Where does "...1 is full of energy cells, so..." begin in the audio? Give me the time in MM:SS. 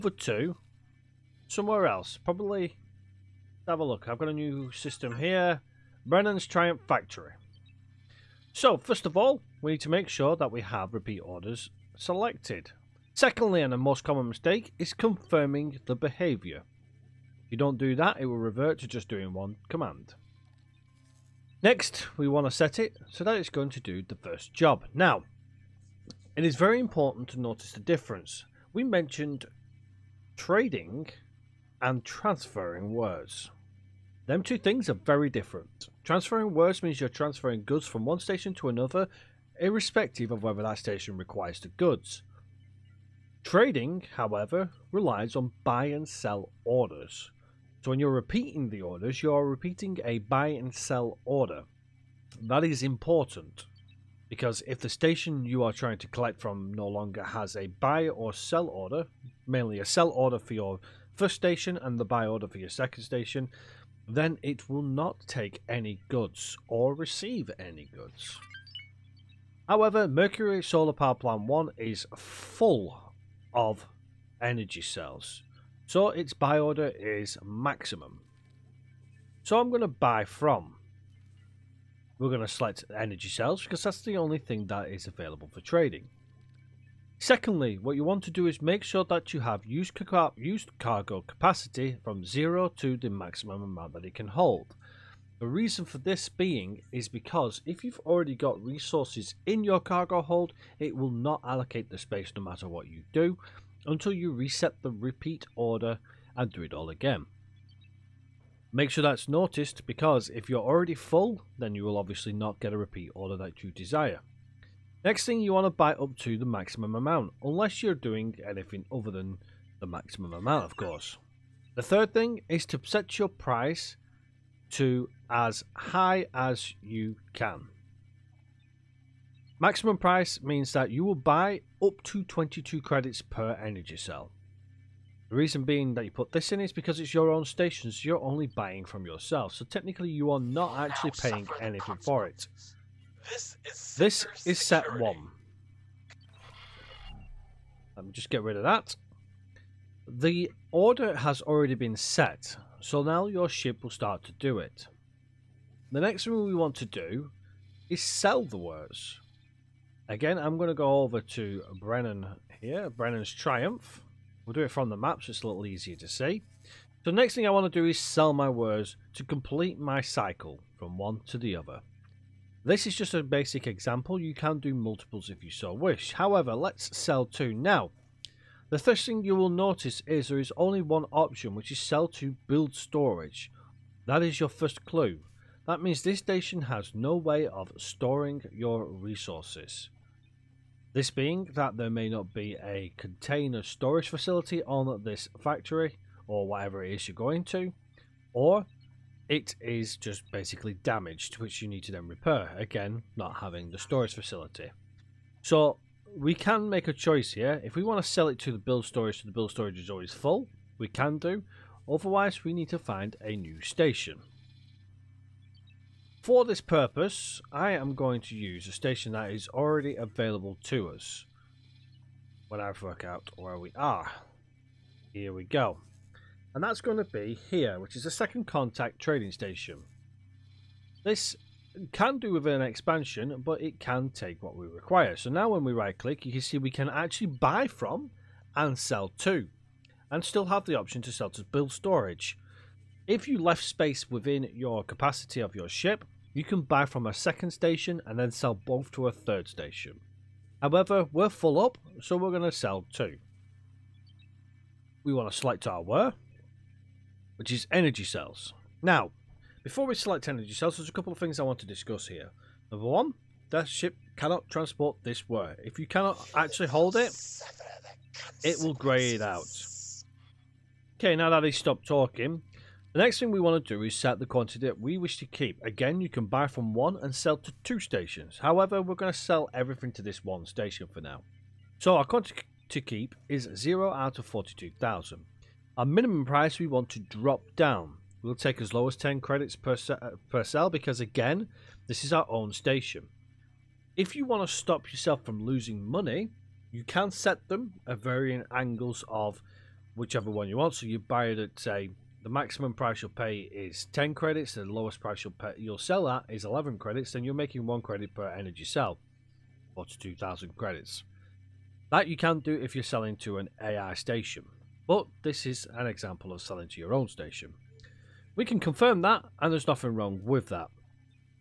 01:11.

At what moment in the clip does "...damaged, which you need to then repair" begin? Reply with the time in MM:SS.
03:20.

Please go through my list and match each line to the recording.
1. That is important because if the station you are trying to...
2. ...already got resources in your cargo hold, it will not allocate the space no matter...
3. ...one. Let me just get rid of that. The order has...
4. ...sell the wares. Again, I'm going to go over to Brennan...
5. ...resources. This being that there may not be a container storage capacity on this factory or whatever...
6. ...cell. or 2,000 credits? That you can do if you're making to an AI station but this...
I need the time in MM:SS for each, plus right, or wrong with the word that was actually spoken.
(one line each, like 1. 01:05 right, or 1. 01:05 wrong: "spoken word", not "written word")
1. 00:52 right
2. 01:38 right
3. 02:24 right
4. 02:38 right
5. 03:08 wrong: "facility", not "capacity"
6. 05:08 wrong: "selling", not "making".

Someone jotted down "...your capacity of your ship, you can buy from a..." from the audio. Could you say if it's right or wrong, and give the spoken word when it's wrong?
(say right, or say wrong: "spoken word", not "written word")
right.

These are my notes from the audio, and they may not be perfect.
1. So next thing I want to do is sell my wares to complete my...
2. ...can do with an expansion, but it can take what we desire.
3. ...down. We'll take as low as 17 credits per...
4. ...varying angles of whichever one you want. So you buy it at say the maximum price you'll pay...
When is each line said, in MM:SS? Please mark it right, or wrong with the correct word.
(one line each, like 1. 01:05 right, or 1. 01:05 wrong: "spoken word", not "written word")
1. 02:47 right
2. 03:51 wrong: "require", not "desire"
3. 04:47 wrong: "10", not "17"
4. 04:57 right.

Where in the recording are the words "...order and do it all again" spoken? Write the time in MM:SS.
01:45.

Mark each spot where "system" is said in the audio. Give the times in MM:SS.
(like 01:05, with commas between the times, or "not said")
00:04.